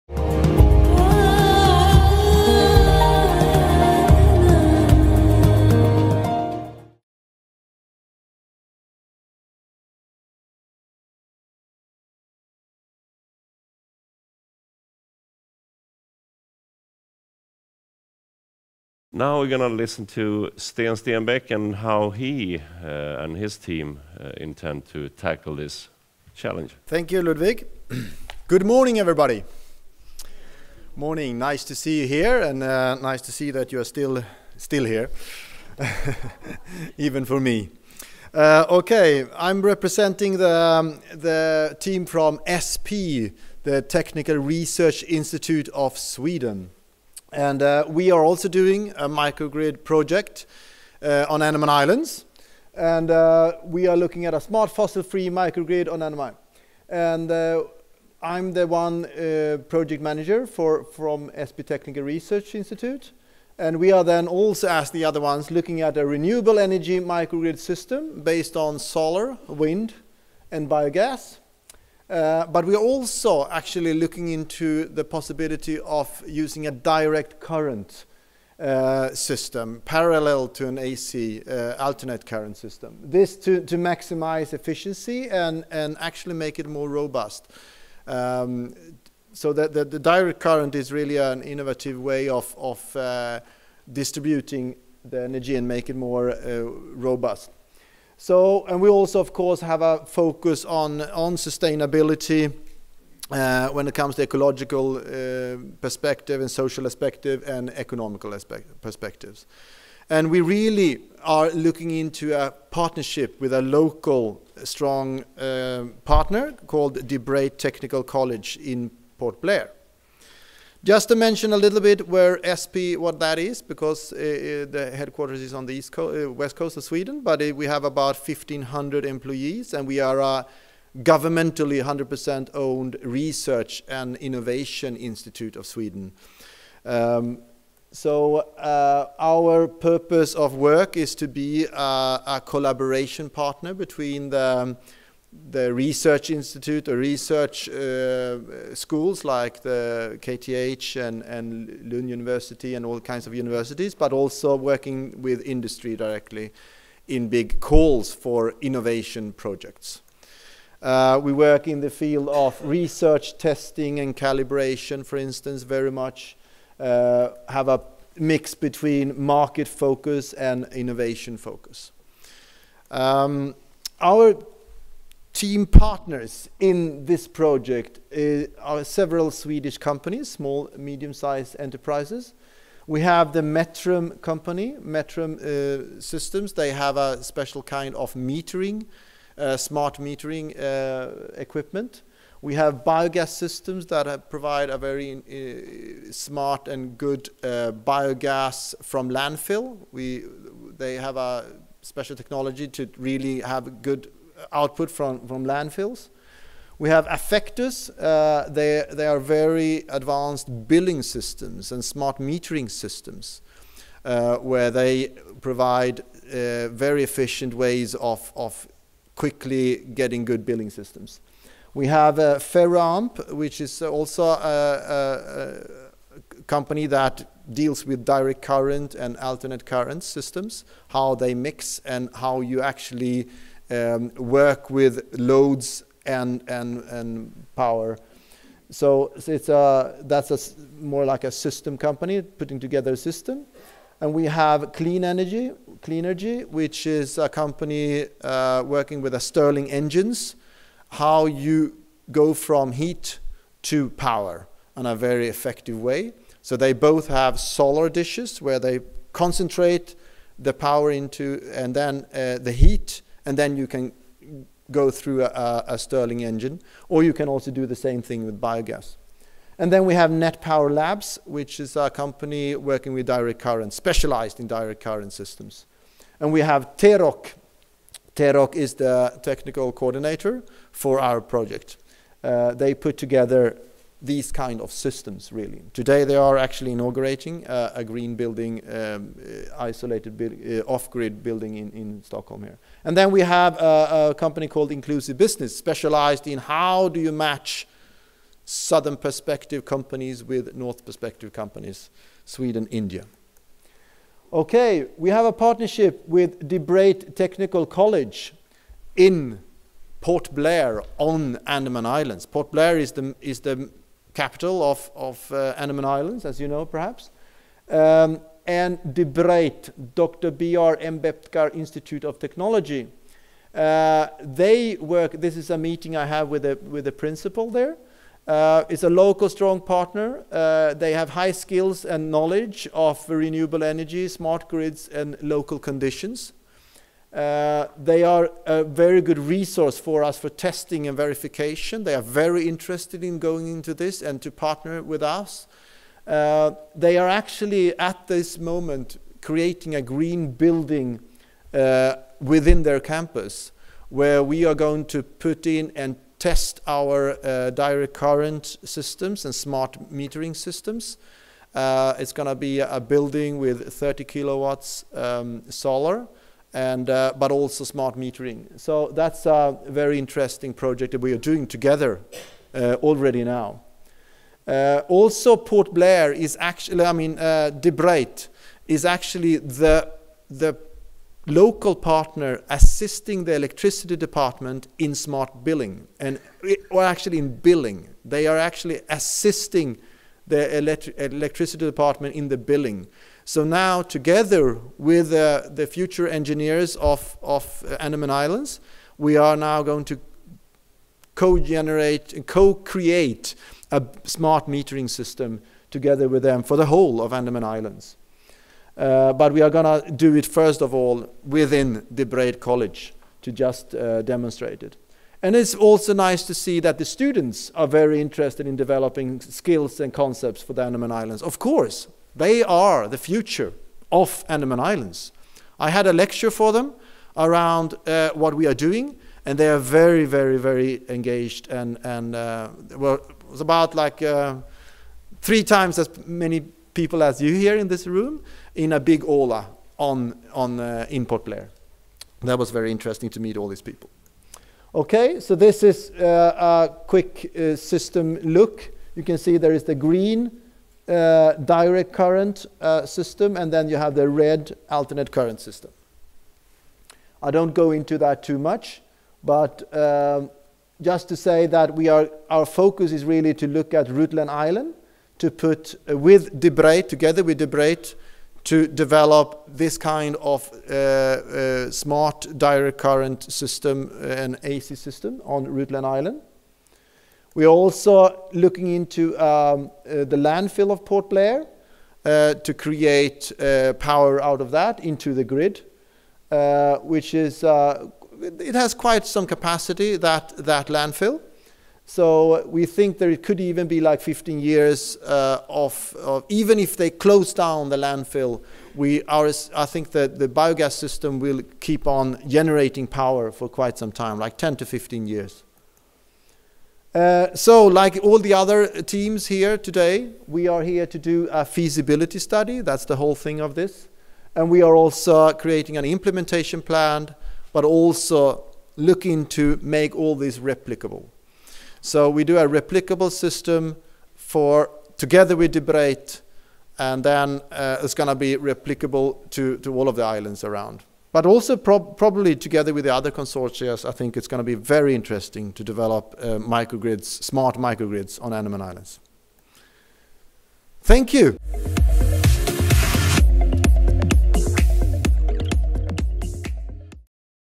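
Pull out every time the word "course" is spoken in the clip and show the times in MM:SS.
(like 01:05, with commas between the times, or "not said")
01:39, 07:01.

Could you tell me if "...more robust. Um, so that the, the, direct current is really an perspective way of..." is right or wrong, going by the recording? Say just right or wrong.
wrong.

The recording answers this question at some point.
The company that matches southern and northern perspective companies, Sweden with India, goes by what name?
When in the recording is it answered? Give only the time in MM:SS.
04:54.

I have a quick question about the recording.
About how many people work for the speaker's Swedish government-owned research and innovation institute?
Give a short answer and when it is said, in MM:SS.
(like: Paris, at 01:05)
1,500, at 02:08.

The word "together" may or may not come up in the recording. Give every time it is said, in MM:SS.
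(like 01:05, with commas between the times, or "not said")
04:02, 04:42, 06:11, 06:33, 06:45, 07:46, 08:44, 08:52.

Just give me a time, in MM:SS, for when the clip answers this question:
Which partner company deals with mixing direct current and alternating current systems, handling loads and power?
03:42.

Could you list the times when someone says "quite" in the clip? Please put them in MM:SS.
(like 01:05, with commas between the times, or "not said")
08:08, 08:23.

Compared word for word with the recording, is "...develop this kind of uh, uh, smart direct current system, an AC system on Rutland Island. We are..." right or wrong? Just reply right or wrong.
right.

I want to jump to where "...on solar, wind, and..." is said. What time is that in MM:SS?
01:08.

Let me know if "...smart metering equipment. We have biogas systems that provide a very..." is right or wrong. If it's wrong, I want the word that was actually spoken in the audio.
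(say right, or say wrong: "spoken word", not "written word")
right.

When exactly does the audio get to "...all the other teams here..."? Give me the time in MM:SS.
08:28.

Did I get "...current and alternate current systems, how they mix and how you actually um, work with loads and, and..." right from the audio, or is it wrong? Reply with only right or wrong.
right.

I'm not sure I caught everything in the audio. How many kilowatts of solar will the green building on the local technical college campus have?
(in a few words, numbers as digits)
30.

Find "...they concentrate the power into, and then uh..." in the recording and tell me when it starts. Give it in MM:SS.
04:18.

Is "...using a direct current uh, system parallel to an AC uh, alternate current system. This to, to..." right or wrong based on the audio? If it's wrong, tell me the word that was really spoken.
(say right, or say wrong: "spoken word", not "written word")
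right.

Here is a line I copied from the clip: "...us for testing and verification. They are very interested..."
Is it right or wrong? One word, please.
right.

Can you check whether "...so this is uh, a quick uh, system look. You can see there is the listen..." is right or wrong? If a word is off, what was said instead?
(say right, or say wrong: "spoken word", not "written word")
wrong: "green", not "listen".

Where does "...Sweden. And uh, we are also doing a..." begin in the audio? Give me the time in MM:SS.
00:45.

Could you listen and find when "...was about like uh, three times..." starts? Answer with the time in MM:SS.
07:13.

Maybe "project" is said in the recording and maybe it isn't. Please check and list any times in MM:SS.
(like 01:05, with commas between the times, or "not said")
00:49, 00:59, 02:39, 02:57, 04:41, 06:10.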